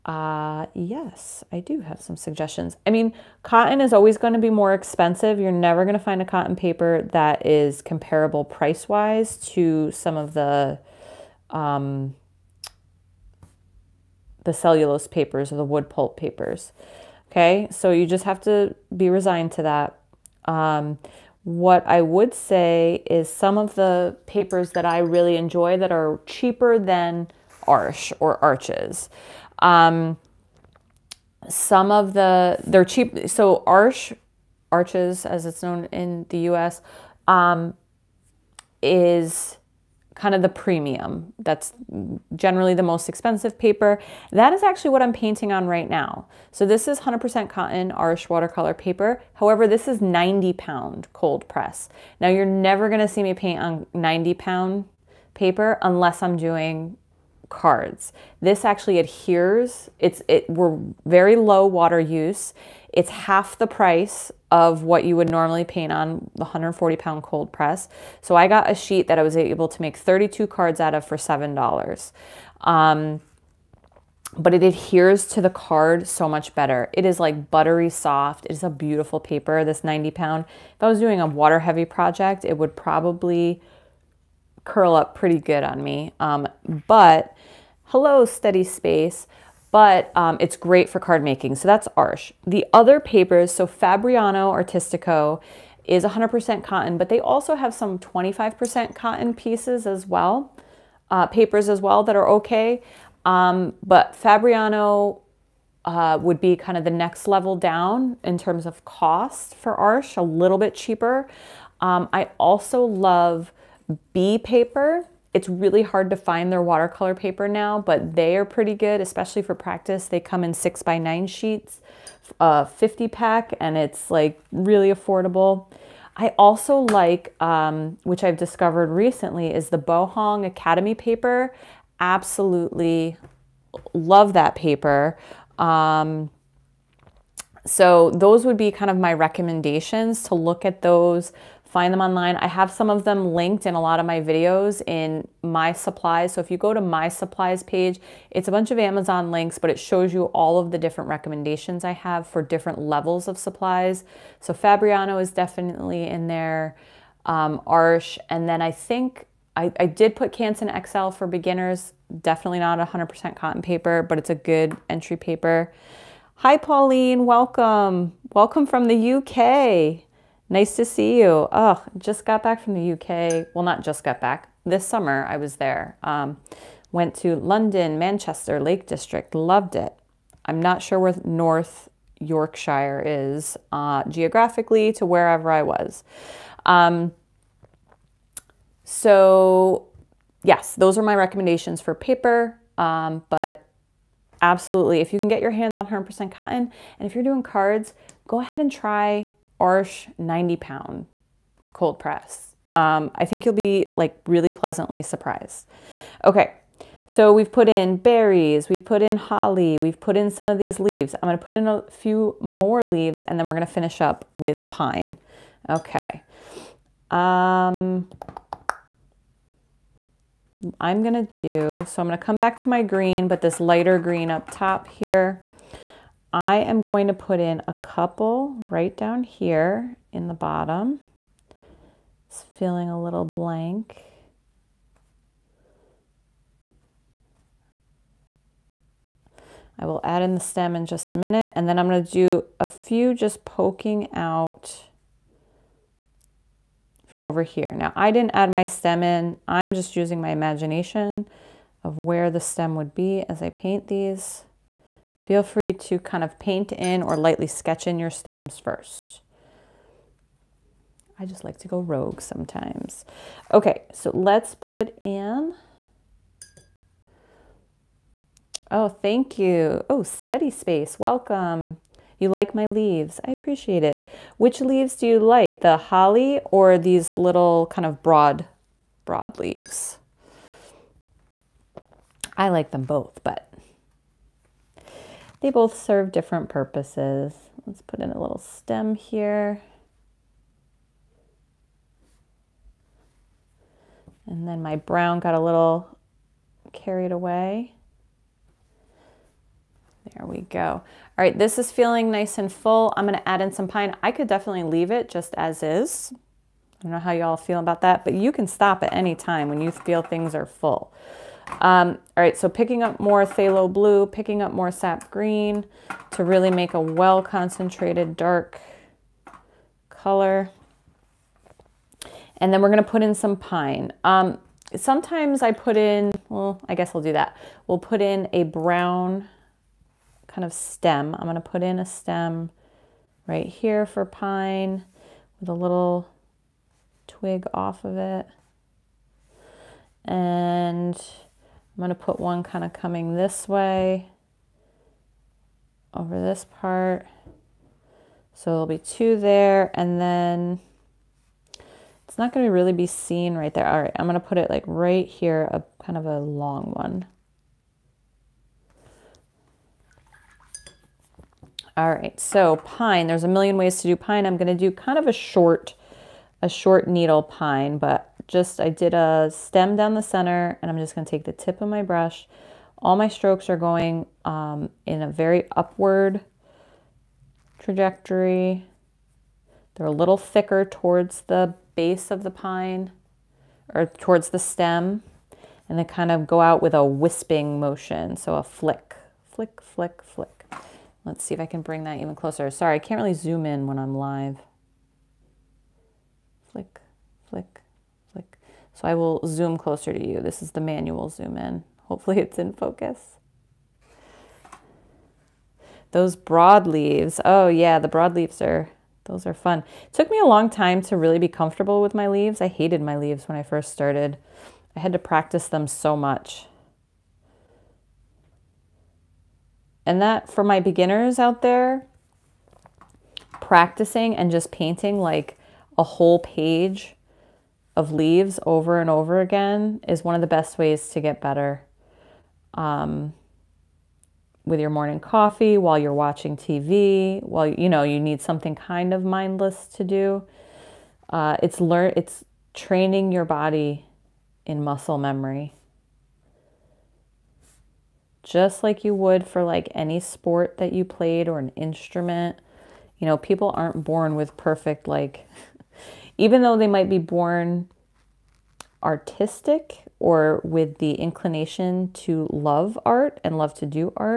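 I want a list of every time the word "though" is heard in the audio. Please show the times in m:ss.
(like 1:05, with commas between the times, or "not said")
7:36.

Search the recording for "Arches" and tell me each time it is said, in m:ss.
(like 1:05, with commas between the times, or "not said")
0:28, 0:34.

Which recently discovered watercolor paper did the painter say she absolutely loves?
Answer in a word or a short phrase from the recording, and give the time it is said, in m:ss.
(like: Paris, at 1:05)
Baohong Academy, at 2:09.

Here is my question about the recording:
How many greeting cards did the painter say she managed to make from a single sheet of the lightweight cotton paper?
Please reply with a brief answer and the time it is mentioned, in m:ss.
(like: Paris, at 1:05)
32, at 1:09.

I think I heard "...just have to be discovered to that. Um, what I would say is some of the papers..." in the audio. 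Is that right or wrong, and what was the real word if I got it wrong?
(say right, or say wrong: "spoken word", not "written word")
wrong: "resigned", not "discovered".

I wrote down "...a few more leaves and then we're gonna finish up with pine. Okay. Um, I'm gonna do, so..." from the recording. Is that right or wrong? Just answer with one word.
right.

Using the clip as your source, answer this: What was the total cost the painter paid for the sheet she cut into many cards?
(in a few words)
$7.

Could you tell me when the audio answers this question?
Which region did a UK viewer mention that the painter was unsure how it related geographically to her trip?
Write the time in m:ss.
3:01.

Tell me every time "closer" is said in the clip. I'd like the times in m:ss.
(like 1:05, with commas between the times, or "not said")
6:32, 6:39.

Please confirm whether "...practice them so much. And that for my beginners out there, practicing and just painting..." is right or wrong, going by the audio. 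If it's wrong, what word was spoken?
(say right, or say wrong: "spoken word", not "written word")
right.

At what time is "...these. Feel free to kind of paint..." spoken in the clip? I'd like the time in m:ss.
4:13.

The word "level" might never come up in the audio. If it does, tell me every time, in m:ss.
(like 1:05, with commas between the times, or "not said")
1:47, 2:32.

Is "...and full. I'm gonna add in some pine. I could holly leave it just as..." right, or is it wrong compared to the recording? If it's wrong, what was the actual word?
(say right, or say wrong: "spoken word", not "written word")
wrong: "definitely", not "holly".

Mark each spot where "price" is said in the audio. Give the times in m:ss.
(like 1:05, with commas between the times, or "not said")
0:08, 1:03.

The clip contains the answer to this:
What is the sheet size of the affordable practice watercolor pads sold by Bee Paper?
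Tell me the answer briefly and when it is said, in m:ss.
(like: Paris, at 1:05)
6 by 9, at 2:00.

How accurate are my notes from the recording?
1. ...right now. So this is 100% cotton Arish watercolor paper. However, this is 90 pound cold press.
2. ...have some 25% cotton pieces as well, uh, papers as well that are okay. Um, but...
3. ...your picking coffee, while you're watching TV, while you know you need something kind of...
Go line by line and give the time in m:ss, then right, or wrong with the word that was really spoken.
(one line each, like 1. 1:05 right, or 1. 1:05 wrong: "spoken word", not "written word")
1. 0:45 right
2. 1:37 right
3. 7:14 wrong: "morning", not "picking".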